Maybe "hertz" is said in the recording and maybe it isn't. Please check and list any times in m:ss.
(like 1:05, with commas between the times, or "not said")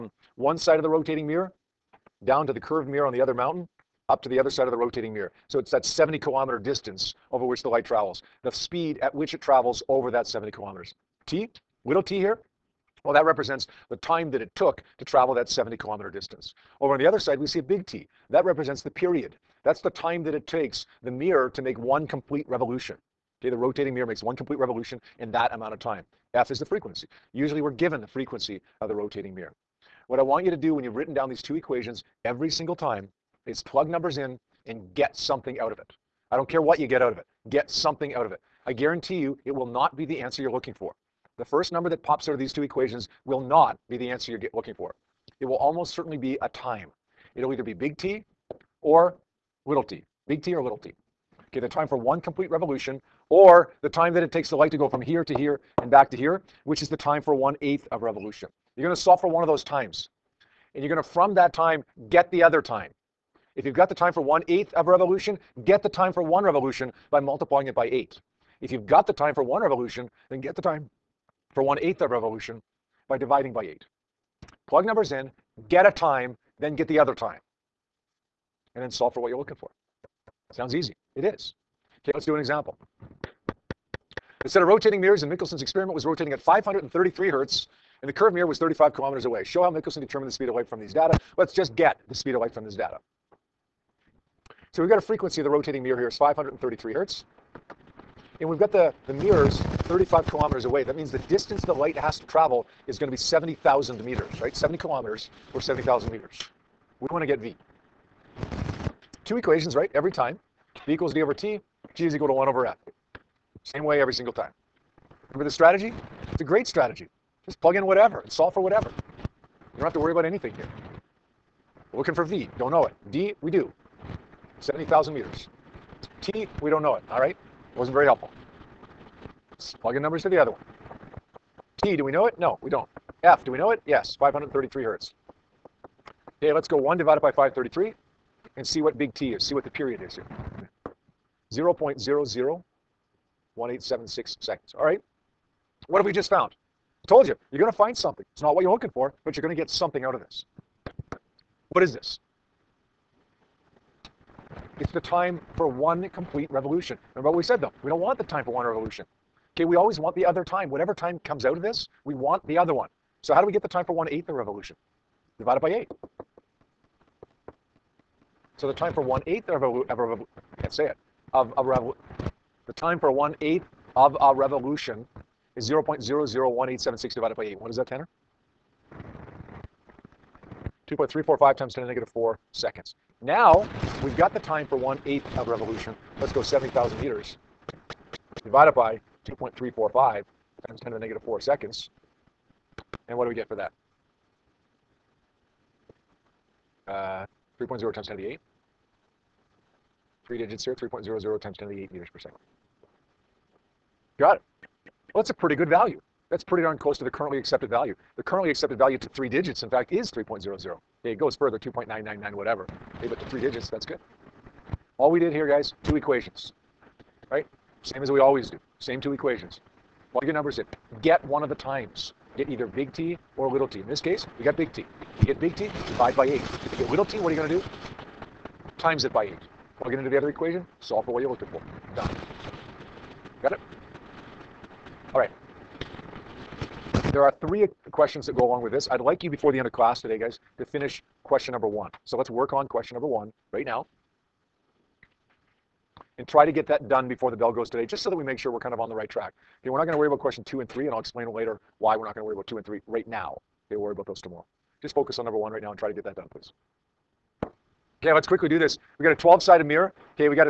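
1:27, 1:36, 2:14.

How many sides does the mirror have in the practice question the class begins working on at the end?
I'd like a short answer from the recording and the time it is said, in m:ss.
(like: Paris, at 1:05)
12, at 4:19.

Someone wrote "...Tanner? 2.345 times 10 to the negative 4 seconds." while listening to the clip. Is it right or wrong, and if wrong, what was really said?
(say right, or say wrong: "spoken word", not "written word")
right.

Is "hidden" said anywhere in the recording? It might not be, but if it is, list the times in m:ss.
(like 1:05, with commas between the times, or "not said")
not said.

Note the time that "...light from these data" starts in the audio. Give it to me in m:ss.
1:30.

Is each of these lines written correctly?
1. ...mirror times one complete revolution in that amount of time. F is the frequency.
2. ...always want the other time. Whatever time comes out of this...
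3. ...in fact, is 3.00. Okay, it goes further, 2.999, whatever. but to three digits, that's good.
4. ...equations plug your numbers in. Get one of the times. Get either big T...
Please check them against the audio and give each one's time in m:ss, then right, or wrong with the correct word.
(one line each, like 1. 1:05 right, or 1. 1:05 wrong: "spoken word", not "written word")
1. 0:23 wrong: "makes", not "times"
2. 2:39 right
3. 3:29 right
4. 3:39 right.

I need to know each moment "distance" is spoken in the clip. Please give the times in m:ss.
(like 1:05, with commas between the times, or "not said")
0:06, 0:16, 1:41.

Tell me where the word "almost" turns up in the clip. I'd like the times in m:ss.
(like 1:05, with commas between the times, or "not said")
0:45.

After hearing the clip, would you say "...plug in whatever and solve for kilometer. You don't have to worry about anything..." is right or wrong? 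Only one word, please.
wrong.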